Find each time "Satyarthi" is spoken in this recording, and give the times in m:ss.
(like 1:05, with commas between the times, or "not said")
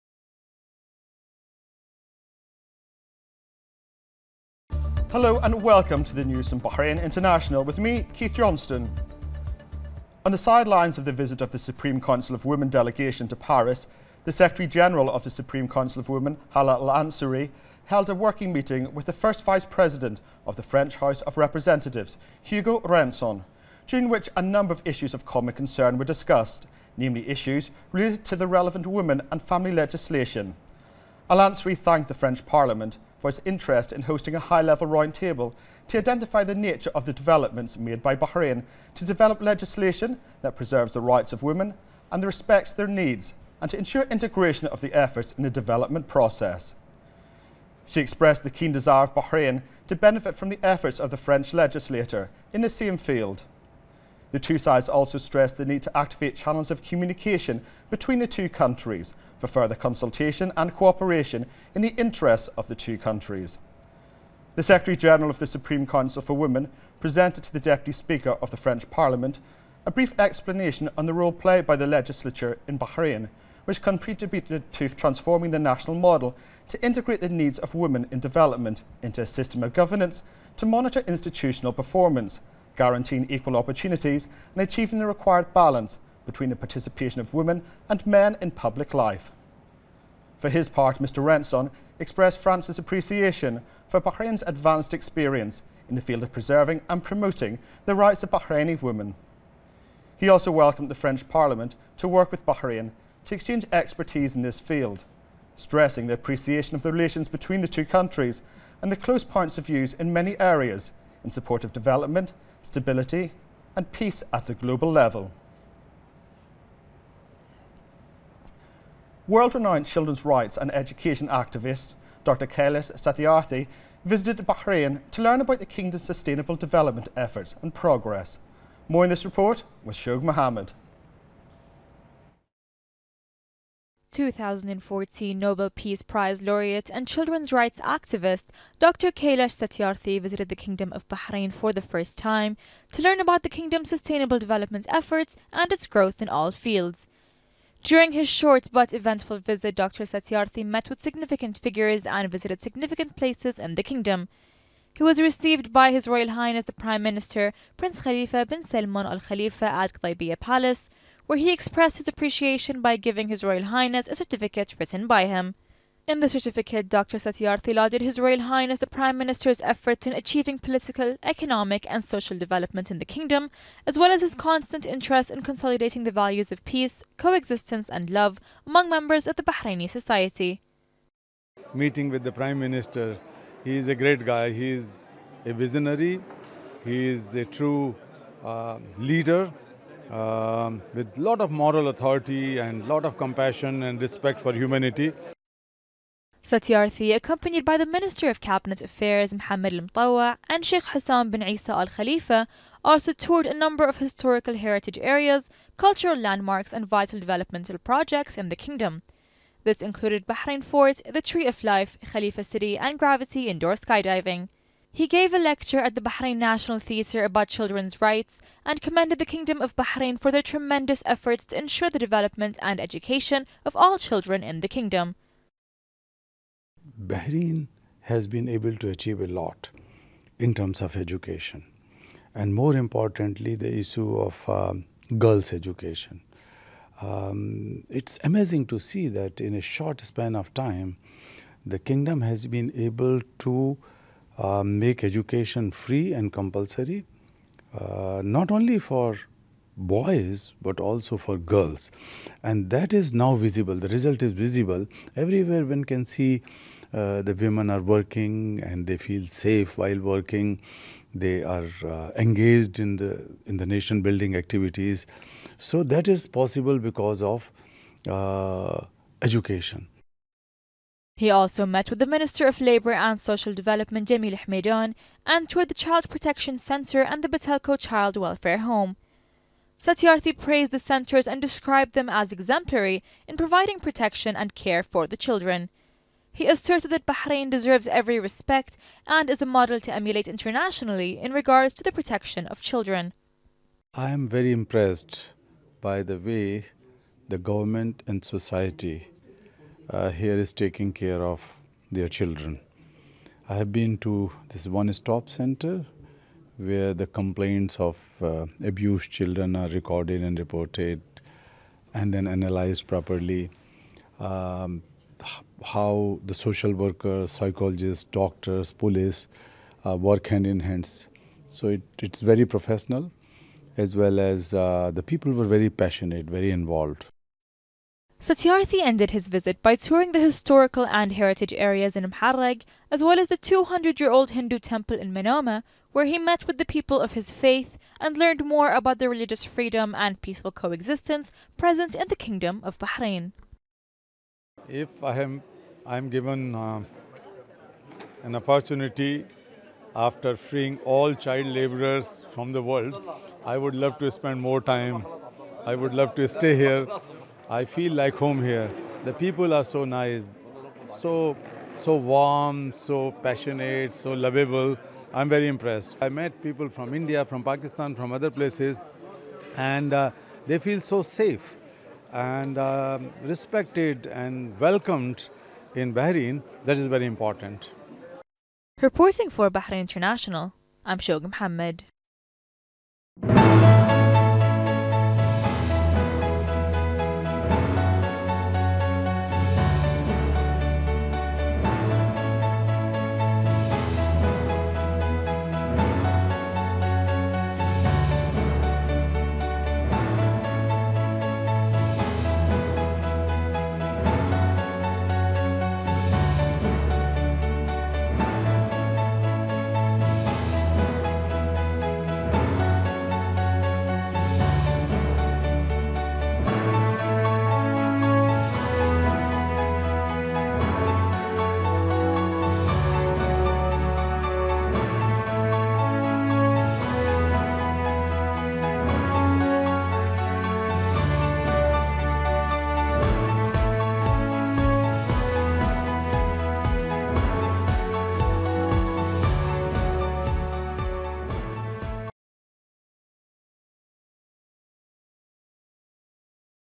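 2:02, 2:19, 2:30, 2:47, 3:16, 4:39, 5:28.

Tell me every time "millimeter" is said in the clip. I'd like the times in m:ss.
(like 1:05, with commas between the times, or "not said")
not said.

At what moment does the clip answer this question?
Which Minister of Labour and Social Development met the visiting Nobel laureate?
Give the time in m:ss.
4:34.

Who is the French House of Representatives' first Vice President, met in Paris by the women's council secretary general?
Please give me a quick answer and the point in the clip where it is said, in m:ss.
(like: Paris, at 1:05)
Hugo Renson, at 0:22.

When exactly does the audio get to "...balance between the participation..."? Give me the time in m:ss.
1:25.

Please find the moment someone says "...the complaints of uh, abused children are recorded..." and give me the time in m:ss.
5:06.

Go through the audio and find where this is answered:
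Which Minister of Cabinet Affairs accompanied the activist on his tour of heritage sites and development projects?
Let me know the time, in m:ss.
3:19.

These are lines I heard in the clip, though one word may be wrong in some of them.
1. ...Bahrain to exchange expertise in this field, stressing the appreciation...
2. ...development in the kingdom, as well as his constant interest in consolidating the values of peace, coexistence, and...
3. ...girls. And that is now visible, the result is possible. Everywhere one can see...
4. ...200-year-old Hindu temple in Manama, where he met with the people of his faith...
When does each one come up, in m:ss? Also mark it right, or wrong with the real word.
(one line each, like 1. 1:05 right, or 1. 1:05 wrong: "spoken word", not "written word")
1. 1:42 right
2. 2:52 right
3. 4:11 wrong: "visible", not "possible"
4. 5:33 right.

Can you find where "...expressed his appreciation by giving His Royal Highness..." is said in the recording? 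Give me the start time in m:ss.
2:41.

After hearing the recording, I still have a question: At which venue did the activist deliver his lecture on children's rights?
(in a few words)
Bahrain National Theatre.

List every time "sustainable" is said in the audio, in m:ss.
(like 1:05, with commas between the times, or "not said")
2:06, 2:23.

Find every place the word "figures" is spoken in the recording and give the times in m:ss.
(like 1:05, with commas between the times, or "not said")
2:31.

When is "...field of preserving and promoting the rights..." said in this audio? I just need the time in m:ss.
1:36.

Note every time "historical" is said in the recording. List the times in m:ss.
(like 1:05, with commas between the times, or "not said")
3:23, 5:30.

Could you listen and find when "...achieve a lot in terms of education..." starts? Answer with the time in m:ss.
3:48.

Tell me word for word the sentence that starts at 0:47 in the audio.
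She expressed the keen desire of Bahrain to benefit from the efforts of the French legislator in the same field.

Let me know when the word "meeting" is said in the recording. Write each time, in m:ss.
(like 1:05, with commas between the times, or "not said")
0:18, 3:01.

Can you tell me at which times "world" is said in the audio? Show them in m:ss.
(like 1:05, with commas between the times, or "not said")
1:59, 5:52.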